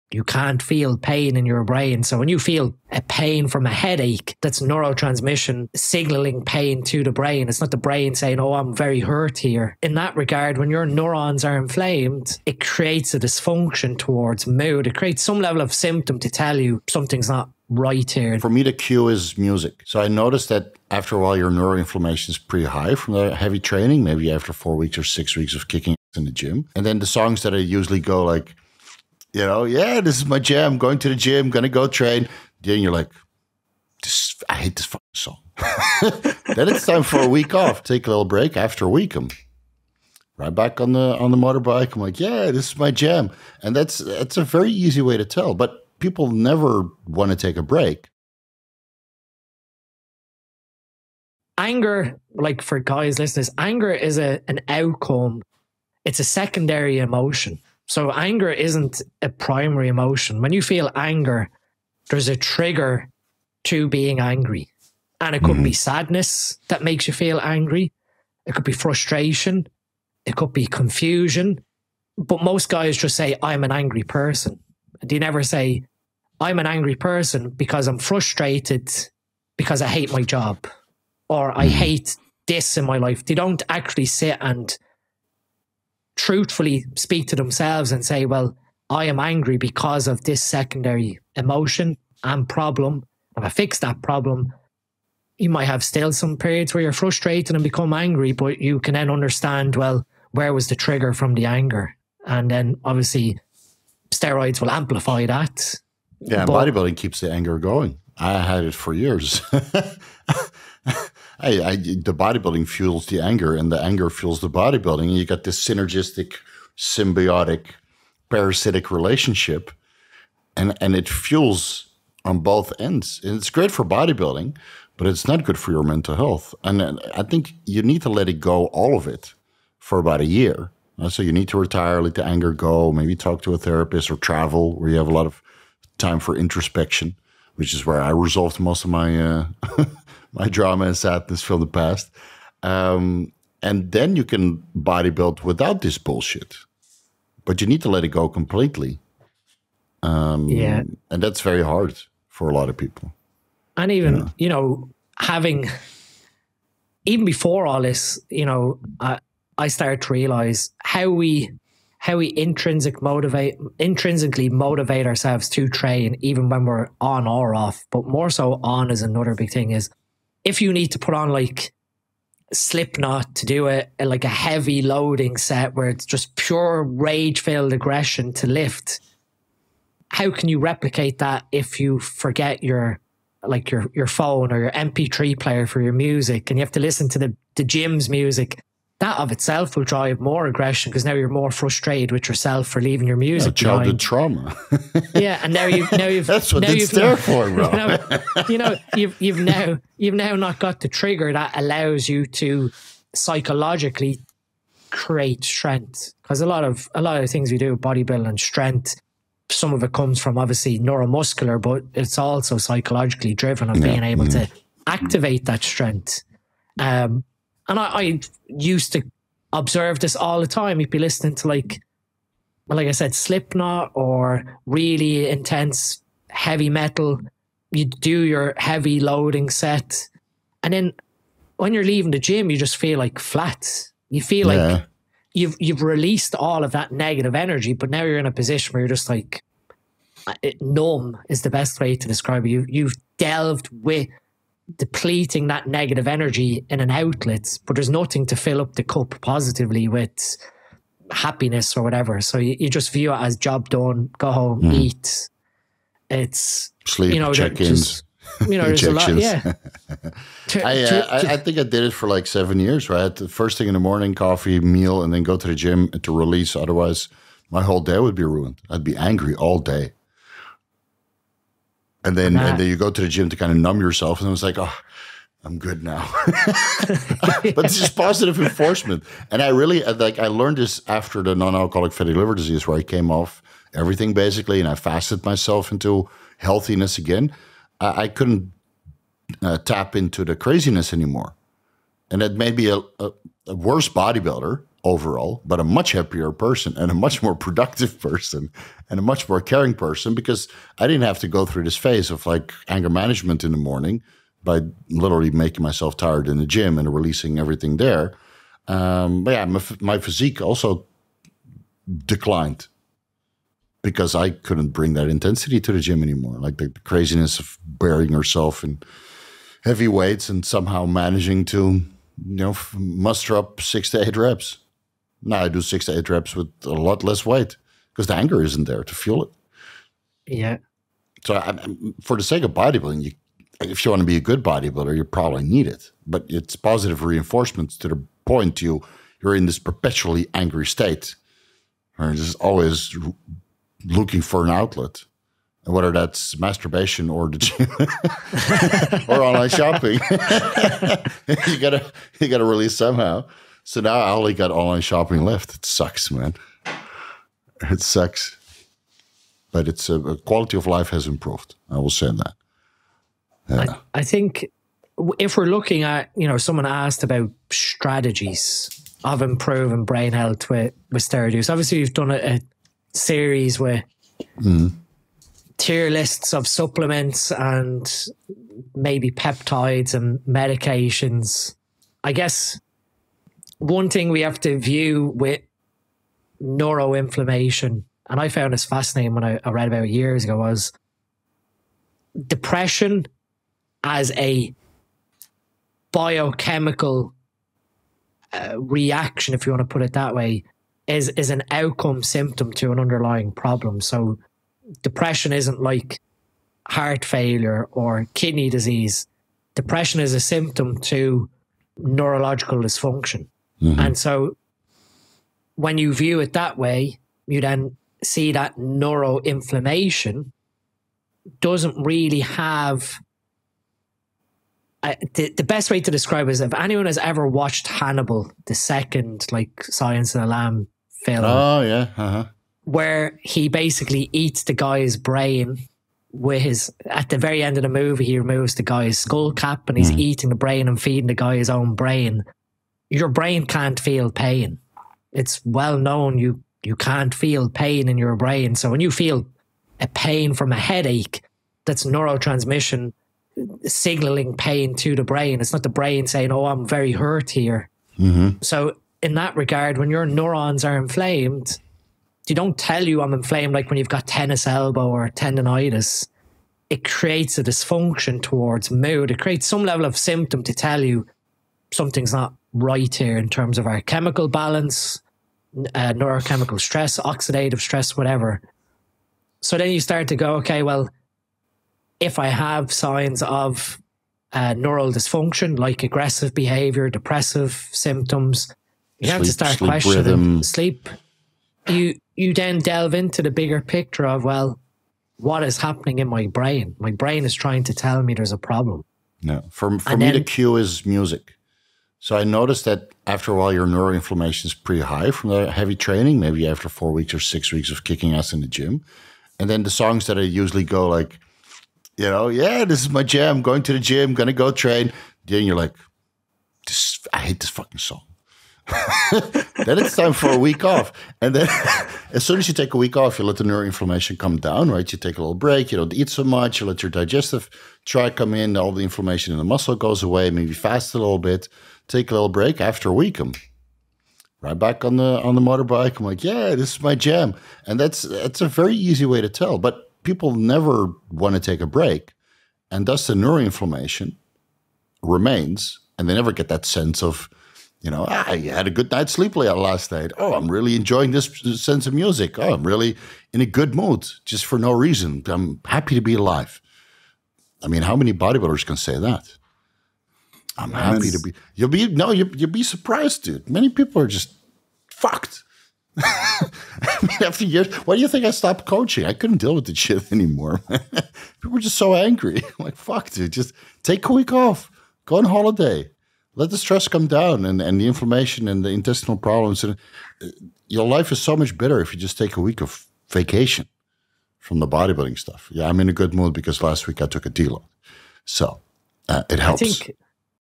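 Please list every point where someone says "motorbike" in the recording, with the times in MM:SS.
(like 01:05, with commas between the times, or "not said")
00:41, 08:55.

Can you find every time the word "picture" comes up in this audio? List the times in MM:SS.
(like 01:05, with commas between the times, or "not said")
08:13.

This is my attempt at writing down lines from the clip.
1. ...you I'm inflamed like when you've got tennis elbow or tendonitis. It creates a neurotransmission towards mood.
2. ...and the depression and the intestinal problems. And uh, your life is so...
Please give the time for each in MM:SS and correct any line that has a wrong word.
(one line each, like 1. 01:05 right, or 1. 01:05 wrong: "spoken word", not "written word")
1. 07:42 wrong: "dysfunction", not "neurotransmission"
2. 09:37 wrong: "inflammation", not "depression".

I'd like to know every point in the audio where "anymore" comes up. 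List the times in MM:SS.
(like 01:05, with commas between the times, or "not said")
04:50, 05:16, 09:30.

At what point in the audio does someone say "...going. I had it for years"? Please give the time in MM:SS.
01:47.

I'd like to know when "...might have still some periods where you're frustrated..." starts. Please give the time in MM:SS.
01:35.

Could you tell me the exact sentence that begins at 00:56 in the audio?
It's a secondary emotion so anger isn't a primary emotion.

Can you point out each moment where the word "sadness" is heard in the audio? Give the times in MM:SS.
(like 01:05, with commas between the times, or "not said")
01:05, 02:20.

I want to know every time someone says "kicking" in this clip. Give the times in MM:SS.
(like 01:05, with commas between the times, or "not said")
00:25, 08:27.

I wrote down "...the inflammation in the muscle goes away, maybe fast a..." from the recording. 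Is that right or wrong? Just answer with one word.
right.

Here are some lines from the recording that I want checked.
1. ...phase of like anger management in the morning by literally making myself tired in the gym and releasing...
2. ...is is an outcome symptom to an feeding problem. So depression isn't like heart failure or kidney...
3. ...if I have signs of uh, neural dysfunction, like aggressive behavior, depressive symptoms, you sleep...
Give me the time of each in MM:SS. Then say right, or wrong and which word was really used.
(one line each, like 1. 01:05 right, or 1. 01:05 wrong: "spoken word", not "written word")
1. 05:01 right
2. 06:40 wrong: "underlying", not "feeding"
3. 08:01 right.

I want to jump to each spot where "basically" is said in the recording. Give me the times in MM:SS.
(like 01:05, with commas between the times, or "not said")
04:44, 07:13.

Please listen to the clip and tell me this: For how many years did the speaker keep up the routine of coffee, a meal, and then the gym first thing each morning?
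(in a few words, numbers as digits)
7 years.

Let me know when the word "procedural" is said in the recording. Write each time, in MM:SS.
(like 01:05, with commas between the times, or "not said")
not said.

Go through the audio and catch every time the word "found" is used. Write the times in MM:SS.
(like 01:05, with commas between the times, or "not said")
06:28.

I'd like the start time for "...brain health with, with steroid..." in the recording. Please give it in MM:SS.
06:09.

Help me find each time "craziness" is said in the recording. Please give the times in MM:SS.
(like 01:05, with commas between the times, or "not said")
04:50, 05:16.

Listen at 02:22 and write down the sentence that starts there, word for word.
Um, and then you can bodybuild without this bullshit.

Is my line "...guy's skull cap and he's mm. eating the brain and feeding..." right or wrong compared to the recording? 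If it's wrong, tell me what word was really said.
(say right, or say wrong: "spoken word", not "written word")
right.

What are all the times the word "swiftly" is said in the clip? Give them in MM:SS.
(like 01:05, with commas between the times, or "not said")
not said.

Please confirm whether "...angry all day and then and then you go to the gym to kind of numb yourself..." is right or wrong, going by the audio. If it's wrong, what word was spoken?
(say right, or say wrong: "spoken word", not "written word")
right.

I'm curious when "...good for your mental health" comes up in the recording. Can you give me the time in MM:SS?
02:05.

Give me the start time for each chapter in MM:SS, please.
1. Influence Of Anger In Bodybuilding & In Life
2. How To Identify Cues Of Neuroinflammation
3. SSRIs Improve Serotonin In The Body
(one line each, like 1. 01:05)
1. 00:52
2. 05:54
3. 09:40.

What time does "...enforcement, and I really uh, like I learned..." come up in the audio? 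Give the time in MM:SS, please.
04:38.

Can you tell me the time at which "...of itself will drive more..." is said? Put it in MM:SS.
03:09.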